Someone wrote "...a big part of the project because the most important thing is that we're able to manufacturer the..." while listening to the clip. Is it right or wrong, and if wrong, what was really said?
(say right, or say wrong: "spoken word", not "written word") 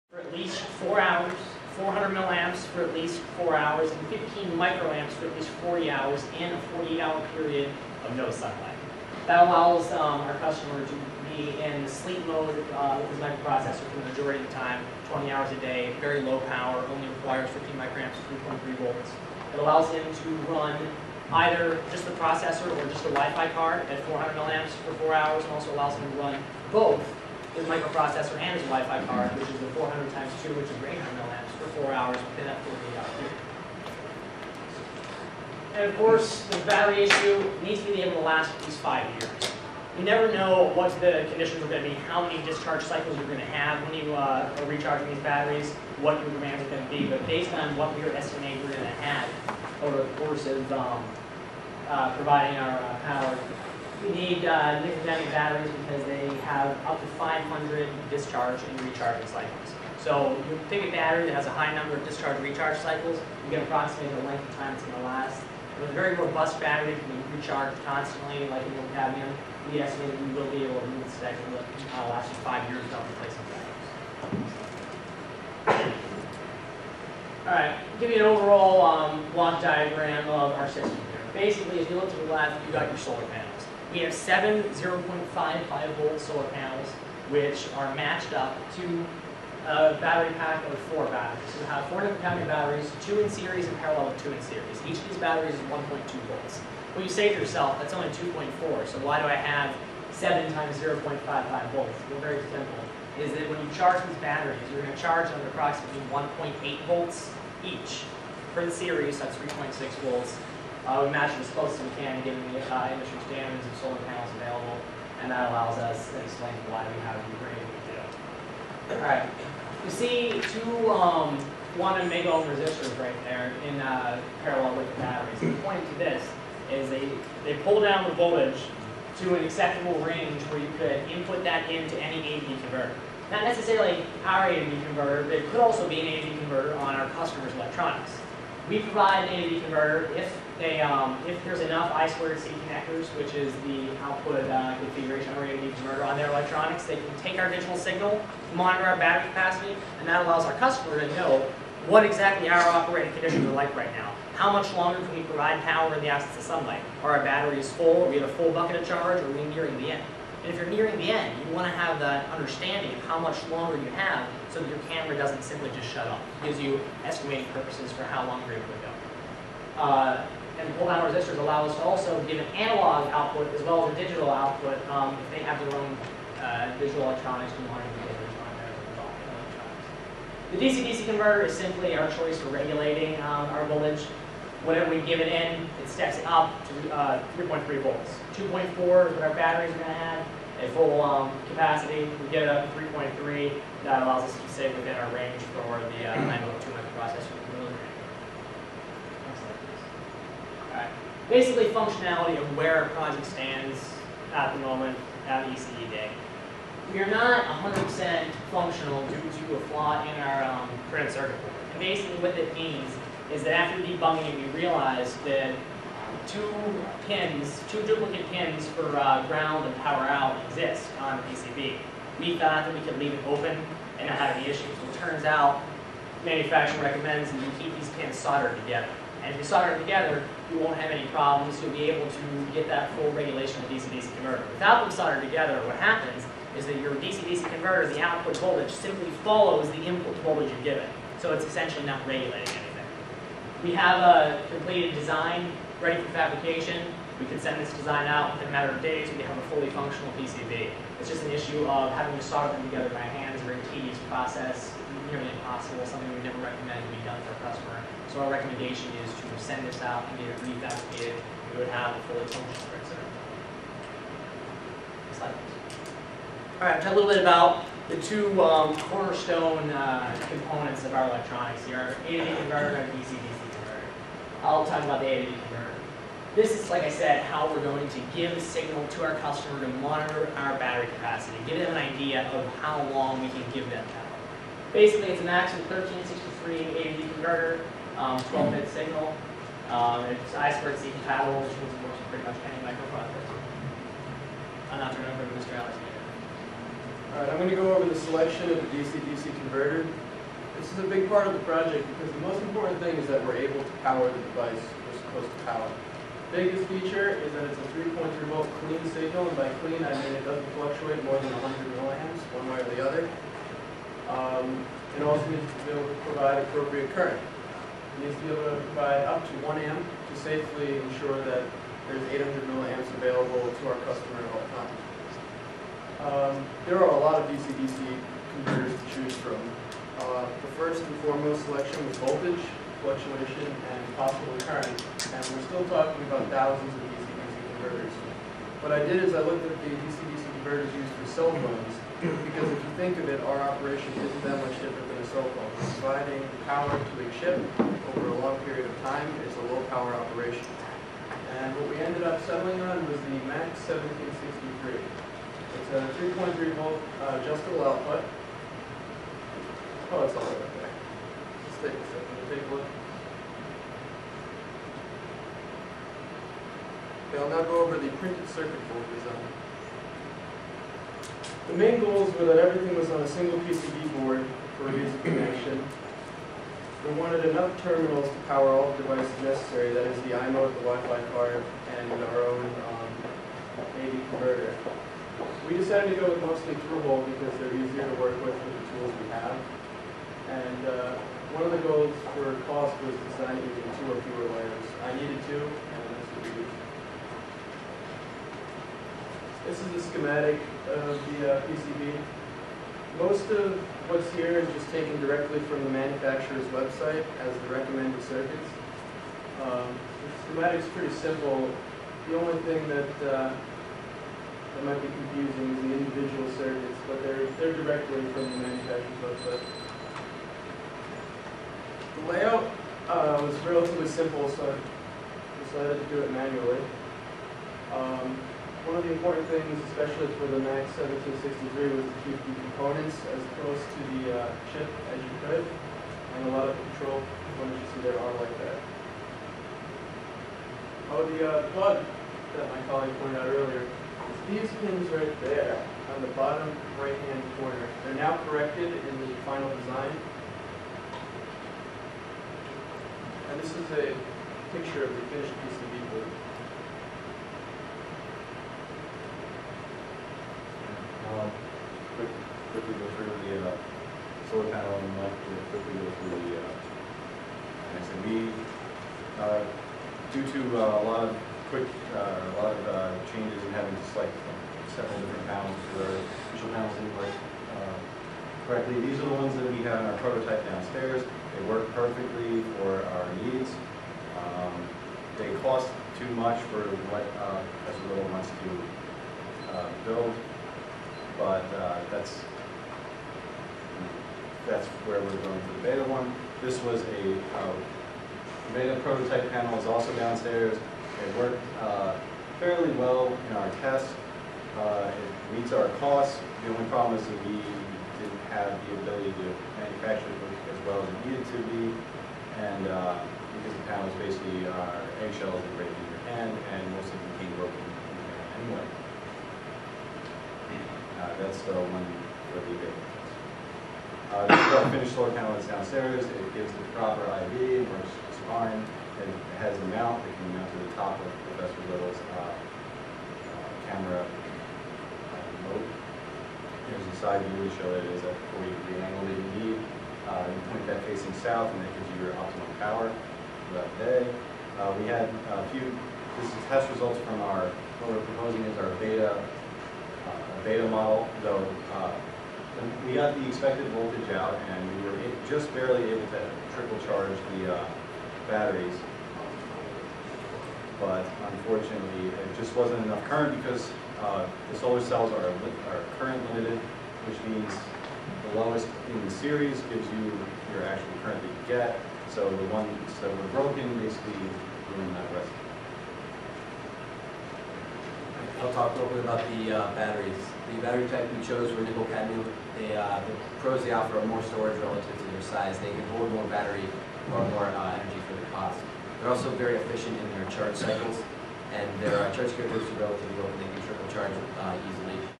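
wrong: "power", not "manufacturer".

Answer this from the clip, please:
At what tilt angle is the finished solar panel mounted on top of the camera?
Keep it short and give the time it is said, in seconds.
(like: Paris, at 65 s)
40 degrees, at 538 s.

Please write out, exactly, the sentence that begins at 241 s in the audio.
So it's essentially not regulating anything.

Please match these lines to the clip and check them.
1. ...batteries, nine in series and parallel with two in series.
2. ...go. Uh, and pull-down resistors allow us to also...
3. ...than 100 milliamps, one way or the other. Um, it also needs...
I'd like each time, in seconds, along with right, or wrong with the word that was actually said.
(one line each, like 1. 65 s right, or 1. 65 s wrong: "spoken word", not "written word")
1. 92 s wrong: "two", not "nine"
2. 169 s right
3. 311 s right.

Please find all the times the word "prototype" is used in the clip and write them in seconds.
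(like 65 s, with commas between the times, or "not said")
479 s, 498 s.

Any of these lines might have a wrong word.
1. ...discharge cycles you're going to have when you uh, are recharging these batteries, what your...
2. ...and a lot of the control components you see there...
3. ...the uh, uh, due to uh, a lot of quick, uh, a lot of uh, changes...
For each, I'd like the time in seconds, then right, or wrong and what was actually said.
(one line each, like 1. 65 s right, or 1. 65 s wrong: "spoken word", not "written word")
1. 42 s right
2. 435 s right
3. 466 s right.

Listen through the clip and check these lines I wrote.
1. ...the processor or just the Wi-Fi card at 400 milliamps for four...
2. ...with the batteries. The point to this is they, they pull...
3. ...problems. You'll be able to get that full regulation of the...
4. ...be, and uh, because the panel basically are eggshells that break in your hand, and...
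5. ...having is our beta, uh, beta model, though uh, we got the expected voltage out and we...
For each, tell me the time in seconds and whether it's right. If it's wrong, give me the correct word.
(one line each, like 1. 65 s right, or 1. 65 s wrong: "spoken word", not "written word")
1. 22 s right
2. 124 s right
3. 231 s right
4. 511 s right
5. 548 s wrong: "proposing", not "having".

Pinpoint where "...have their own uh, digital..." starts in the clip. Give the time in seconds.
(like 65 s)
175 s.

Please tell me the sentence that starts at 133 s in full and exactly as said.
Not necessarily our A/D converter, but it could also be an A/D converter on our customer's electronics.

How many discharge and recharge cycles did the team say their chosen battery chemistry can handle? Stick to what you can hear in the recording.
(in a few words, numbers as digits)
500.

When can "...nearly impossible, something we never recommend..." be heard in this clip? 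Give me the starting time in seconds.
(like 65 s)
255 s.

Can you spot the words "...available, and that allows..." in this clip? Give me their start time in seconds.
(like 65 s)
114 s.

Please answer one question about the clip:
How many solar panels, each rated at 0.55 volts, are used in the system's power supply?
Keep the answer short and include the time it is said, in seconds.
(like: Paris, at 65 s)
7, at 84 s.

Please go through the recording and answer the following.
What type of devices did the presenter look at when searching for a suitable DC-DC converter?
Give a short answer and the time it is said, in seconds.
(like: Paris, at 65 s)
cell phones, at 341 s.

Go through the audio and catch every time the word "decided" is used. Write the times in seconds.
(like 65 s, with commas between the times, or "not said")
385 s, 425 s.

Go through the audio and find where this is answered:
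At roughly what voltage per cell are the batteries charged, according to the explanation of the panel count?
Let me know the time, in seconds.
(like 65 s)
106 s.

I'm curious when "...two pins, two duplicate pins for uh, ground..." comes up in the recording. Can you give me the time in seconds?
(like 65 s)
216 s.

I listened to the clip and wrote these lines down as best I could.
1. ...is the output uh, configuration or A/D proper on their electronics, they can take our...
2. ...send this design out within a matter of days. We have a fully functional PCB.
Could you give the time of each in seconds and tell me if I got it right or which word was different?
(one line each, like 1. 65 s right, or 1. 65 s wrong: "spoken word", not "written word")
1. 143 s wrong: "converter", not "proper"
2. 247 s right.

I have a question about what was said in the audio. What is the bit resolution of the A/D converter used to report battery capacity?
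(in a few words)
12-bit.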